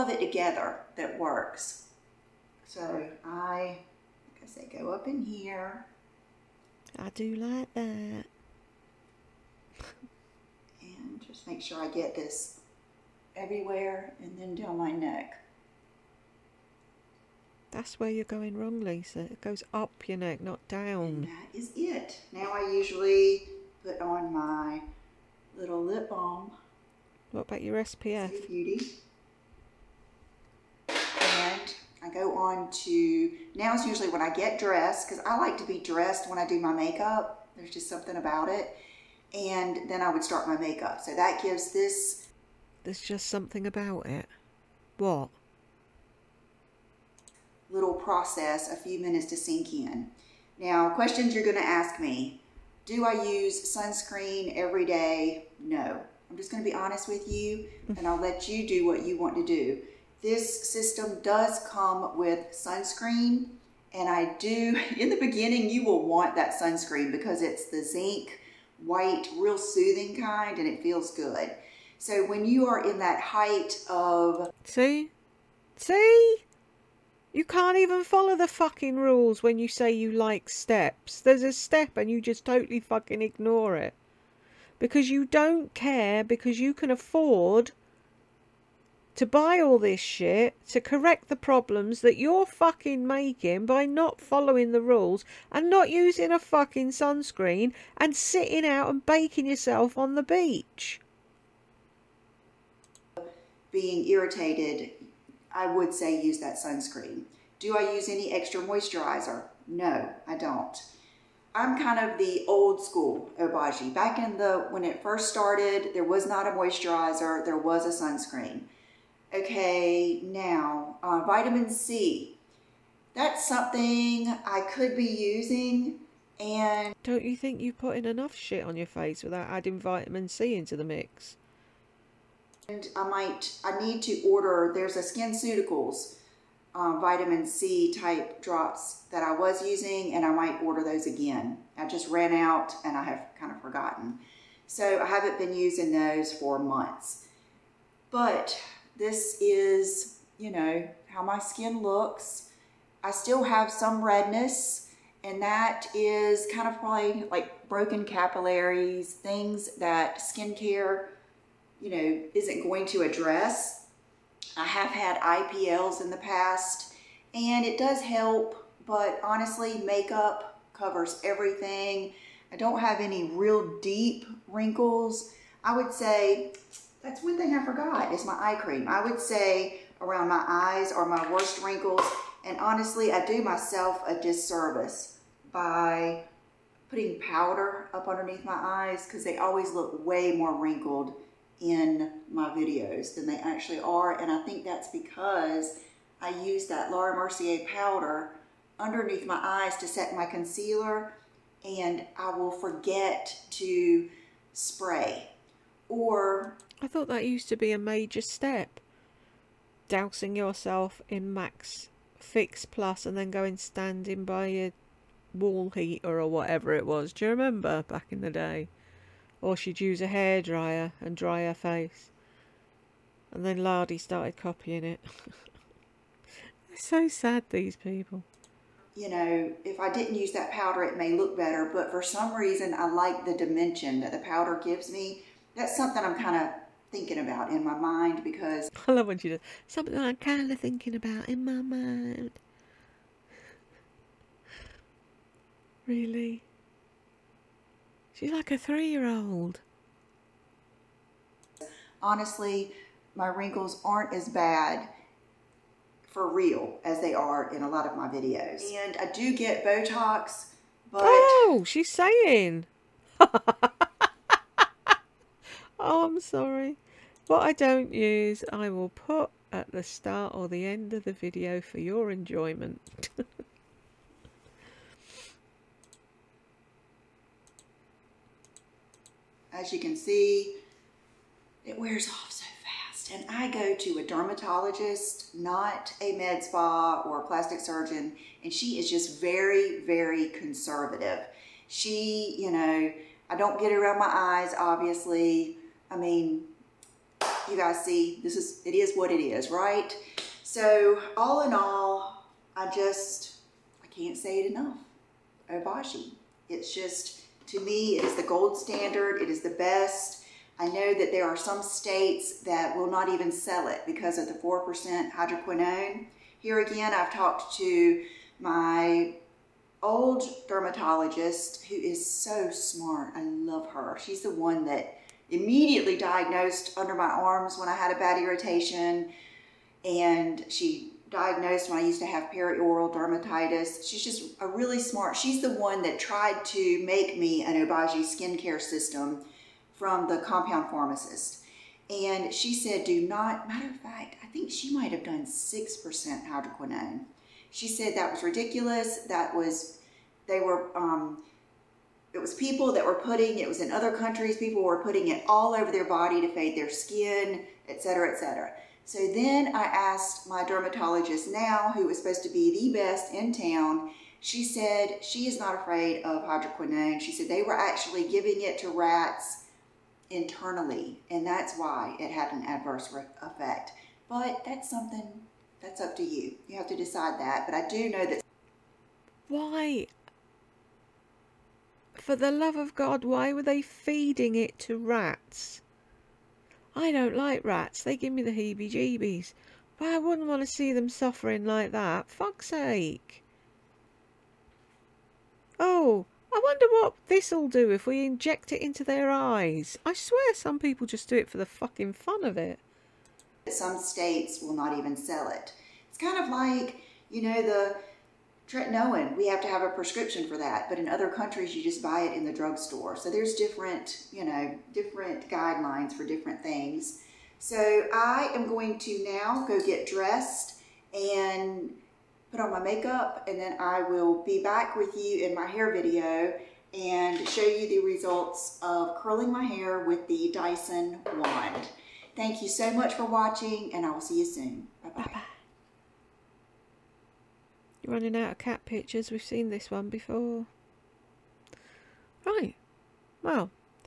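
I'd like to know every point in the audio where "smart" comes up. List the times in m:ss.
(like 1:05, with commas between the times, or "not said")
5:22, 5:34.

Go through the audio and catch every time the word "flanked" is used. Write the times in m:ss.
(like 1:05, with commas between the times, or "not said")
not said.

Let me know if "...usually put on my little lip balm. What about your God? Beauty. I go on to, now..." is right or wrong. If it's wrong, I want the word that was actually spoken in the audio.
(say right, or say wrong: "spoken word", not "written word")
wrong: "SPF", not "God".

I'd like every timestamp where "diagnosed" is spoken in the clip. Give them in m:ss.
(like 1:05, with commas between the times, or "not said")
5:25, 5:31.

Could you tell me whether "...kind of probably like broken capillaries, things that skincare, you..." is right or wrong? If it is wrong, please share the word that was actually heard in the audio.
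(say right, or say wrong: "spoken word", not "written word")
right.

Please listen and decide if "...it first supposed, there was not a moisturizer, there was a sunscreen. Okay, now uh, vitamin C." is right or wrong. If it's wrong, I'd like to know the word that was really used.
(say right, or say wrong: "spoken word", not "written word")
wrong: "started", not "supposed".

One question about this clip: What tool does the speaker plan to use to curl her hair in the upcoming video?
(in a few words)
Dyson wand.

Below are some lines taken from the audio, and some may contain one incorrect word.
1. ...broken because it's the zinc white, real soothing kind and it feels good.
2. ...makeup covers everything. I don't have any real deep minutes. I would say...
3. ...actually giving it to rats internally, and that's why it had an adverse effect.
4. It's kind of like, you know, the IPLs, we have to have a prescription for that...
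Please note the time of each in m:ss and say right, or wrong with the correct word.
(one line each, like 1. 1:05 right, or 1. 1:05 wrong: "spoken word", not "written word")
1. 1:06 wrong: "sunscreen", not "broken"
2. 2:49 wrong: "wrinkles", not "minutes"
3. 6:07 right
4. 6:45 wrong: "Tretinoin", not "IPLs".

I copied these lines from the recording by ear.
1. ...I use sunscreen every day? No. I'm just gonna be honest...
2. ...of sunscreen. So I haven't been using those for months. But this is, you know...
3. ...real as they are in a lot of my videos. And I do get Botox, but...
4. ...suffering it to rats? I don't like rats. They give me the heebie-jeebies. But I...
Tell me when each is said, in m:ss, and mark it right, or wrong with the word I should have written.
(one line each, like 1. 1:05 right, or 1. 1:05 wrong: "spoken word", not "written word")
1. 0:53 right
2. 2:23 wrong: "forgotten", not "sunscreen"
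3. 4:16 right
4. 6:23 wrong: "feeding", not "suffering".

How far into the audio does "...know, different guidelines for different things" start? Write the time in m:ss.
6:54.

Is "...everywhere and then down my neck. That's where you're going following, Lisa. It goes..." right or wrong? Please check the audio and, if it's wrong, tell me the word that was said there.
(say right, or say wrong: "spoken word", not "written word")
wrong: "wrong", not "following".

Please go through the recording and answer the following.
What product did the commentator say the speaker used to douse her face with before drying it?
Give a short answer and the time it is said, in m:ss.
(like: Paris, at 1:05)
Max Fix Plus, at 3:31.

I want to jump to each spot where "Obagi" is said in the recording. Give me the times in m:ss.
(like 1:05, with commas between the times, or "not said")
1:53, 5:05, 5:37.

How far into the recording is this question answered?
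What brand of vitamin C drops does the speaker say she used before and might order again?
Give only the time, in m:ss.
2:14.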